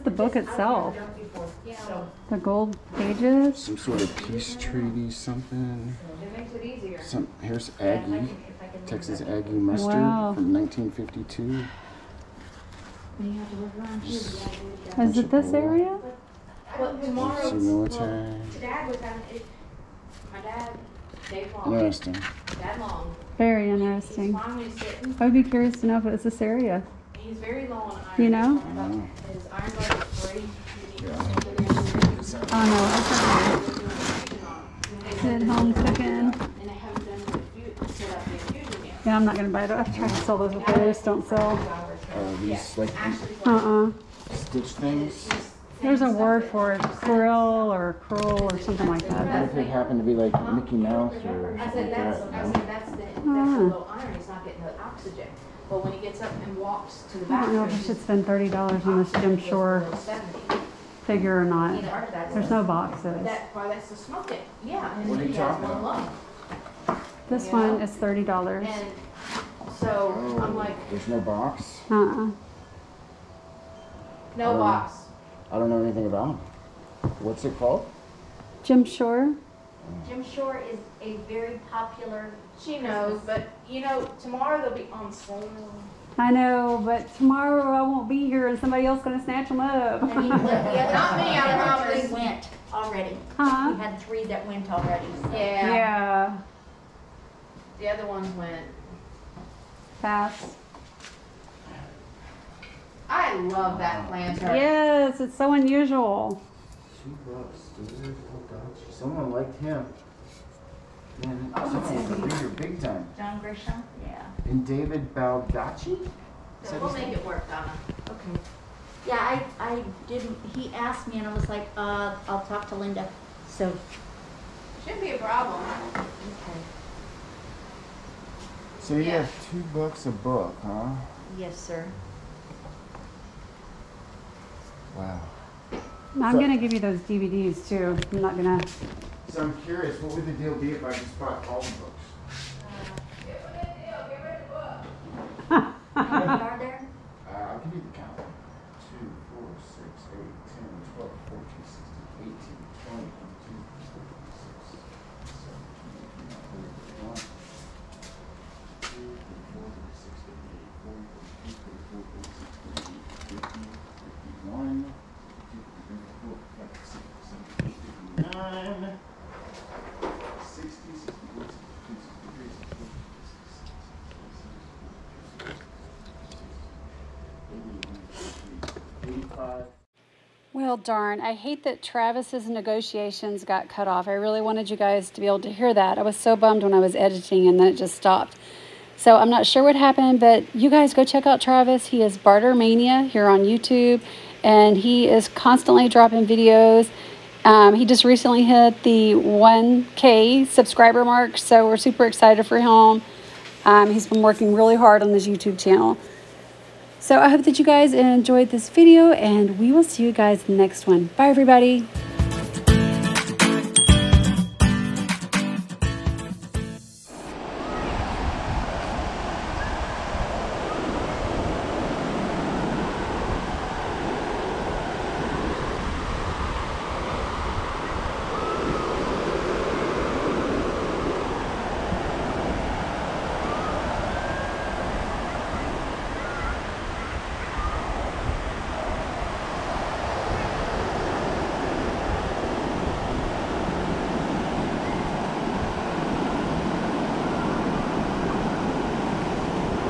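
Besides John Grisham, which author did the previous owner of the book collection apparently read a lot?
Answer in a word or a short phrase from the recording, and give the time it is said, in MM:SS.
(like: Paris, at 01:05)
David Baldacci, at 01:54.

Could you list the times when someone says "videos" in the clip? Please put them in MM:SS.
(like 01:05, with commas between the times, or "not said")
03:16, 03:28.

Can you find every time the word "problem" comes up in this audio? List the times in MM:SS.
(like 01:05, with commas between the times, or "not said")
02:05.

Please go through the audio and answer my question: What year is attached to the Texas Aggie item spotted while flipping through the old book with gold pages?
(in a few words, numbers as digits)
1952.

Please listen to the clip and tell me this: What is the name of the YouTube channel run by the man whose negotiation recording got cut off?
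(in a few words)
Barter Mania.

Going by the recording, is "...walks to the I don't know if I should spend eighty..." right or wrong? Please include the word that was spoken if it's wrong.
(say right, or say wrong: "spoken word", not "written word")
wrong: "thirty", not "eighty".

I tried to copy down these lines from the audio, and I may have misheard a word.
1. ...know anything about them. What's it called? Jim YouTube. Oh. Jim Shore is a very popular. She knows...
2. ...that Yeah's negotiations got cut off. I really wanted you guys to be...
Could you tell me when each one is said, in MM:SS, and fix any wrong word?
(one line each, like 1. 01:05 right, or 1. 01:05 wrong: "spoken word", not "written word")
1. 01:15 wrong: "Shore", not "YouTube"
2. 03:01 wrong: "Travis", not "Yeah".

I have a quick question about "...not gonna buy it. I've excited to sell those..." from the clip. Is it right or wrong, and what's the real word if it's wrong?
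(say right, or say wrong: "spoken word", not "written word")
wrong: "tried", not "excited".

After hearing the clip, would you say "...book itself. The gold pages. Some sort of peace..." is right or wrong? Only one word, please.
right.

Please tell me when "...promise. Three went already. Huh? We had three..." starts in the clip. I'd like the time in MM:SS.
01:31.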